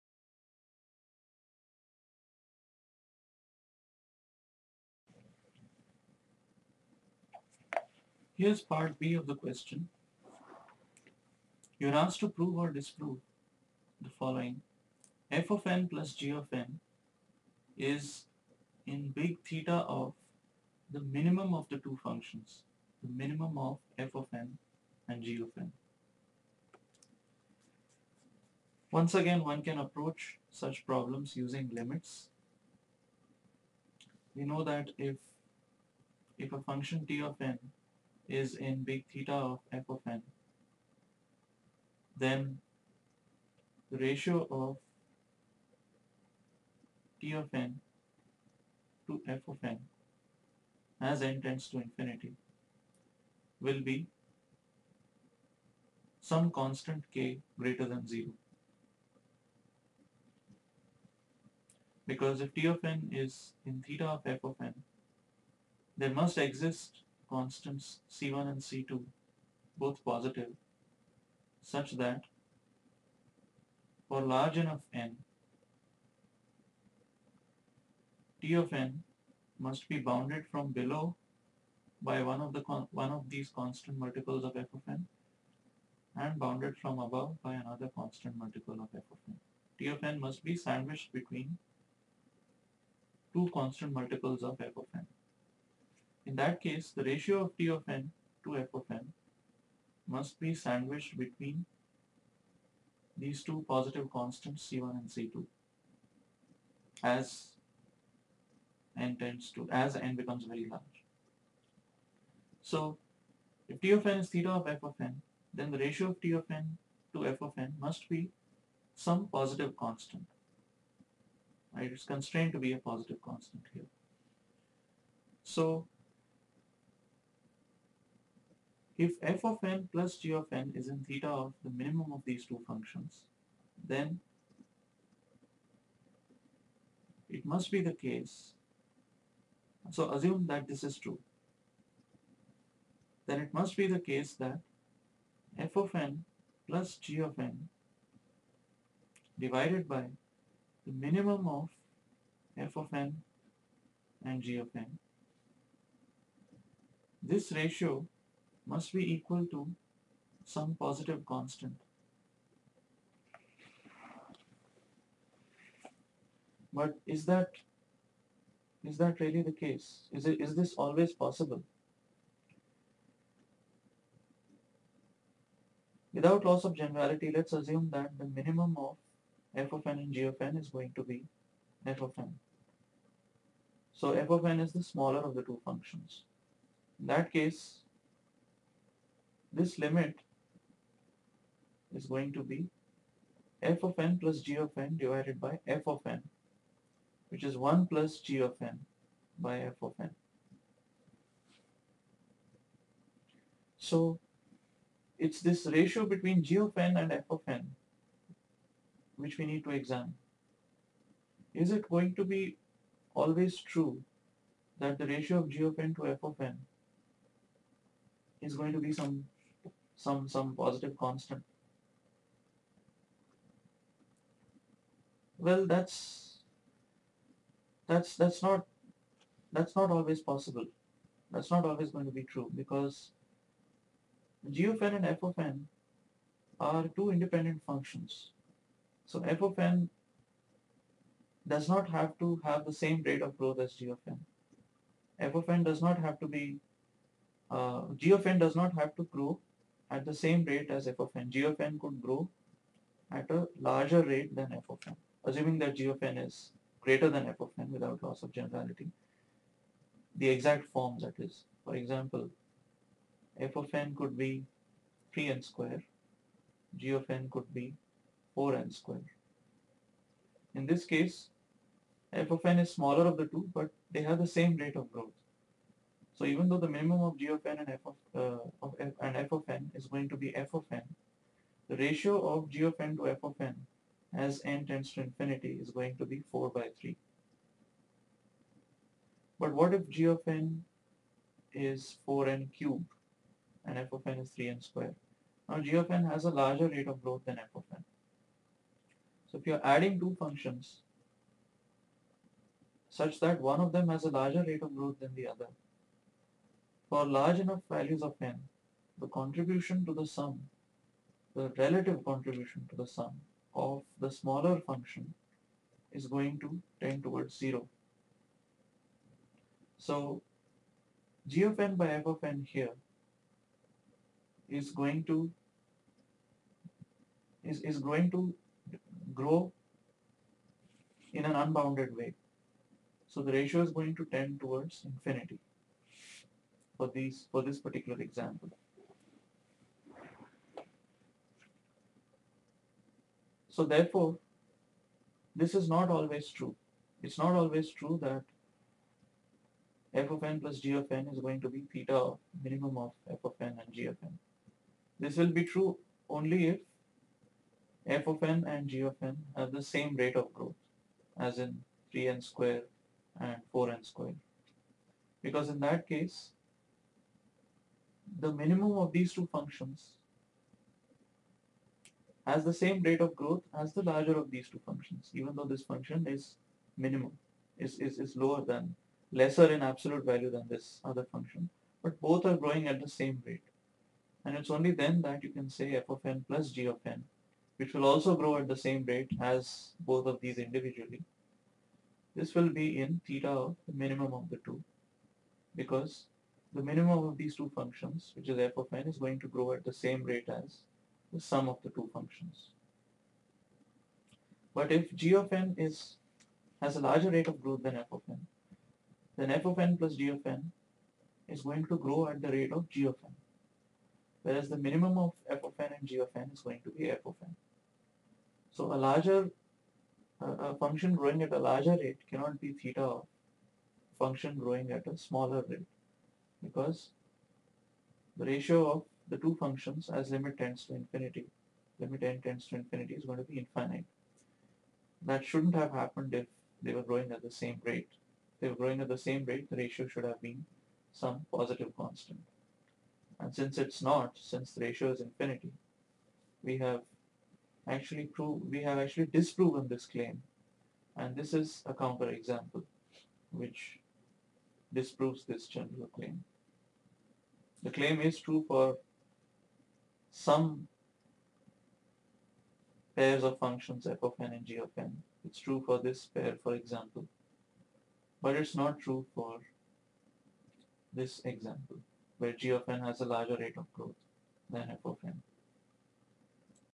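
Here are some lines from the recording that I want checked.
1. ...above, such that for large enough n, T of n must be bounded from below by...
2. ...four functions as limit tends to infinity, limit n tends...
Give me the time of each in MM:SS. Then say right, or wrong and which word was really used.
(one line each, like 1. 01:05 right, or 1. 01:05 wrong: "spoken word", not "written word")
1. 01:10 wrong: "positive", not "above"
2. 07:09 wrong: "two", not "four".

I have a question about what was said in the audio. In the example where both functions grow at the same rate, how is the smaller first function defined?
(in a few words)
3n^2.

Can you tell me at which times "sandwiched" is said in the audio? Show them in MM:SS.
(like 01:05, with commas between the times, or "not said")
01:30, 01:40.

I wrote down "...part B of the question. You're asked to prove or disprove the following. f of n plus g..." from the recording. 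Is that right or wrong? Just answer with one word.
right.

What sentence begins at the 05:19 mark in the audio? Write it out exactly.
So g of n by f of n here is going to is, is going to grow in an unbounded way.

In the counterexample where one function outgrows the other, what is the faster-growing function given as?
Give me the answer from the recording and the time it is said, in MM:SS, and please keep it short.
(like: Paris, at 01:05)
4n^3, at 04:52.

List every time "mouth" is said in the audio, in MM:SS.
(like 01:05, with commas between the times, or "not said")
not said.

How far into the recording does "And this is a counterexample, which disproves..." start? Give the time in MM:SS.
07:30.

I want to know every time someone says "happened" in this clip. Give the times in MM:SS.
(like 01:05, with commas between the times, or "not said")
07:15.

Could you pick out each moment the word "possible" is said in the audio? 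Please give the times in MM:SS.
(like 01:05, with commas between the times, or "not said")
02:51, 03:50.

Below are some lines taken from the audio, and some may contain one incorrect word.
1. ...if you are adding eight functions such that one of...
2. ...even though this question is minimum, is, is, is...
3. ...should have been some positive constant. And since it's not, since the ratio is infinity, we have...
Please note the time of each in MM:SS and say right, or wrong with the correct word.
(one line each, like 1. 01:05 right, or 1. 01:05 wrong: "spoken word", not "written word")
1. 04:59 wrong: "two", not "eight"
2. 06:15 wrong: "function", not "question"
3. 07:19 right.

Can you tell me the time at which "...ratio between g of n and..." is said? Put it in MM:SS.
03:25.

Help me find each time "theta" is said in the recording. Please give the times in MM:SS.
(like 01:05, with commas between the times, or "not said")
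00:19, 00:39, 01:03, 01:54, 02:11, 05:51, 06:33, 07:02.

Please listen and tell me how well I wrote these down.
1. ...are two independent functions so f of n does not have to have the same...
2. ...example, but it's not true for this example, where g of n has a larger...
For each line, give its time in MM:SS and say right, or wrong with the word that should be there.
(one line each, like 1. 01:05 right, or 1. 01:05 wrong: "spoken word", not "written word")
1. 03:56 right
2. 07:46 right.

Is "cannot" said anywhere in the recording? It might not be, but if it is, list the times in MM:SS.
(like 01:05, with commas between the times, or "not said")
07:02.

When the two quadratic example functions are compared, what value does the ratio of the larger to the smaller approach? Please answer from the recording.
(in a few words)
4/3.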